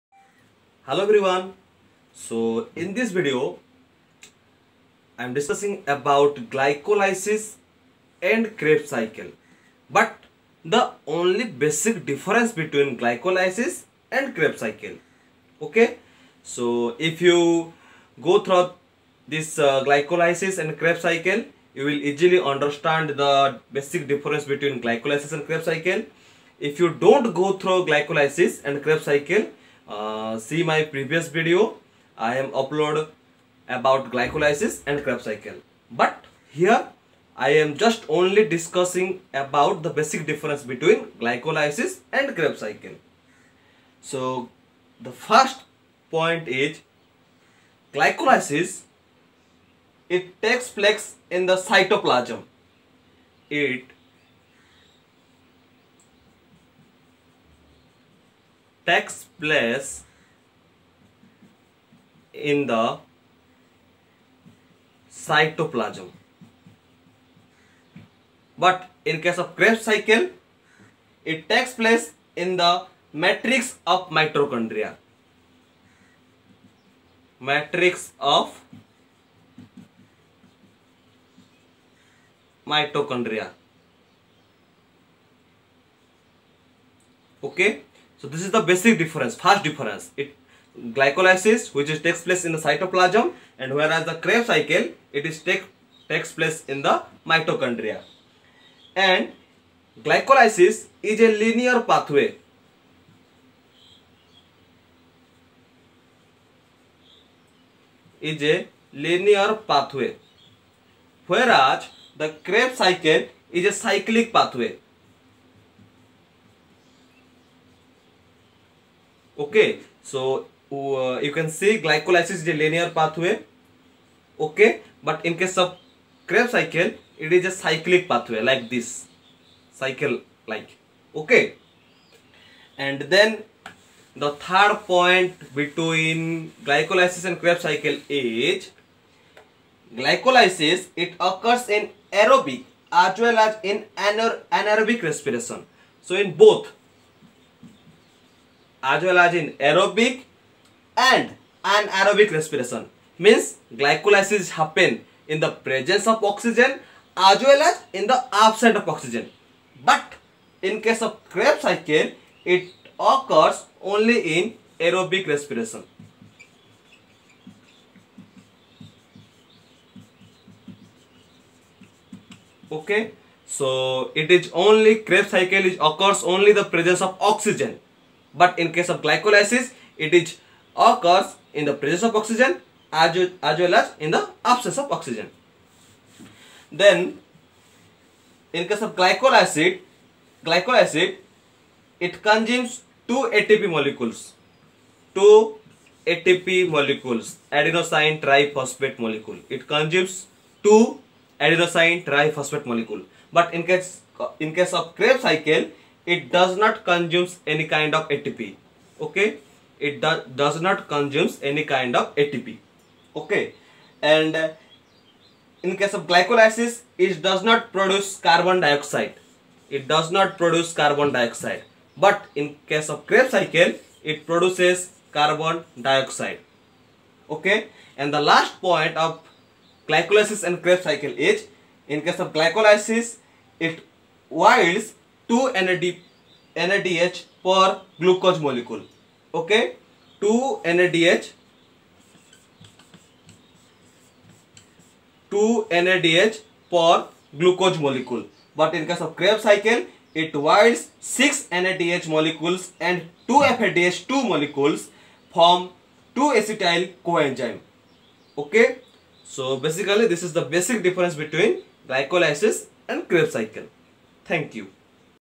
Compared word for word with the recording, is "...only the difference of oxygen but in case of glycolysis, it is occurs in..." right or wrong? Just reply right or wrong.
wrong.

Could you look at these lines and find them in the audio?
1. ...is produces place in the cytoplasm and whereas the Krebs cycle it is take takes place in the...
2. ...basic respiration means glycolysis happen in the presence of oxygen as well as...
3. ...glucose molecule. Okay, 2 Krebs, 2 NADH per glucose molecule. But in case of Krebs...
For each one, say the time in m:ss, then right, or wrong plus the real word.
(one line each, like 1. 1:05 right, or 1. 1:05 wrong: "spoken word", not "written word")
1. 1:31 wrong: "takes", not "produces"
2. 2:31 wrong: "anaerobic", not "basic"
3. 3:57 wrong: "NADH", not "Krebs".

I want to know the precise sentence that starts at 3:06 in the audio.
Then in case of glycolysis, acid, it consumes two ATP molecules, two ATP molecules, adenosine triphosphate molecule.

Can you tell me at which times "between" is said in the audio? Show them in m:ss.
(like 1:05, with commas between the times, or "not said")
0:12, 0:24, 0:40, 2:15, 4:21.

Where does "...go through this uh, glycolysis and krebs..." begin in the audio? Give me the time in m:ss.
0:18.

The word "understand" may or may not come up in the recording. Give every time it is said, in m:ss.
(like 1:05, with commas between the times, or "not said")
0:22.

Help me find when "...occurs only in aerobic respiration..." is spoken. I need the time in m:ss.
2:42.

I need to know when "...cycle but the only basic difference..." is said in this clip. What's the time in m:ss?
0:08.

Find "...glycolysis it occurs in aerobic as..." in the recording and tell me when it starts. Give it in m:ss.
2:20.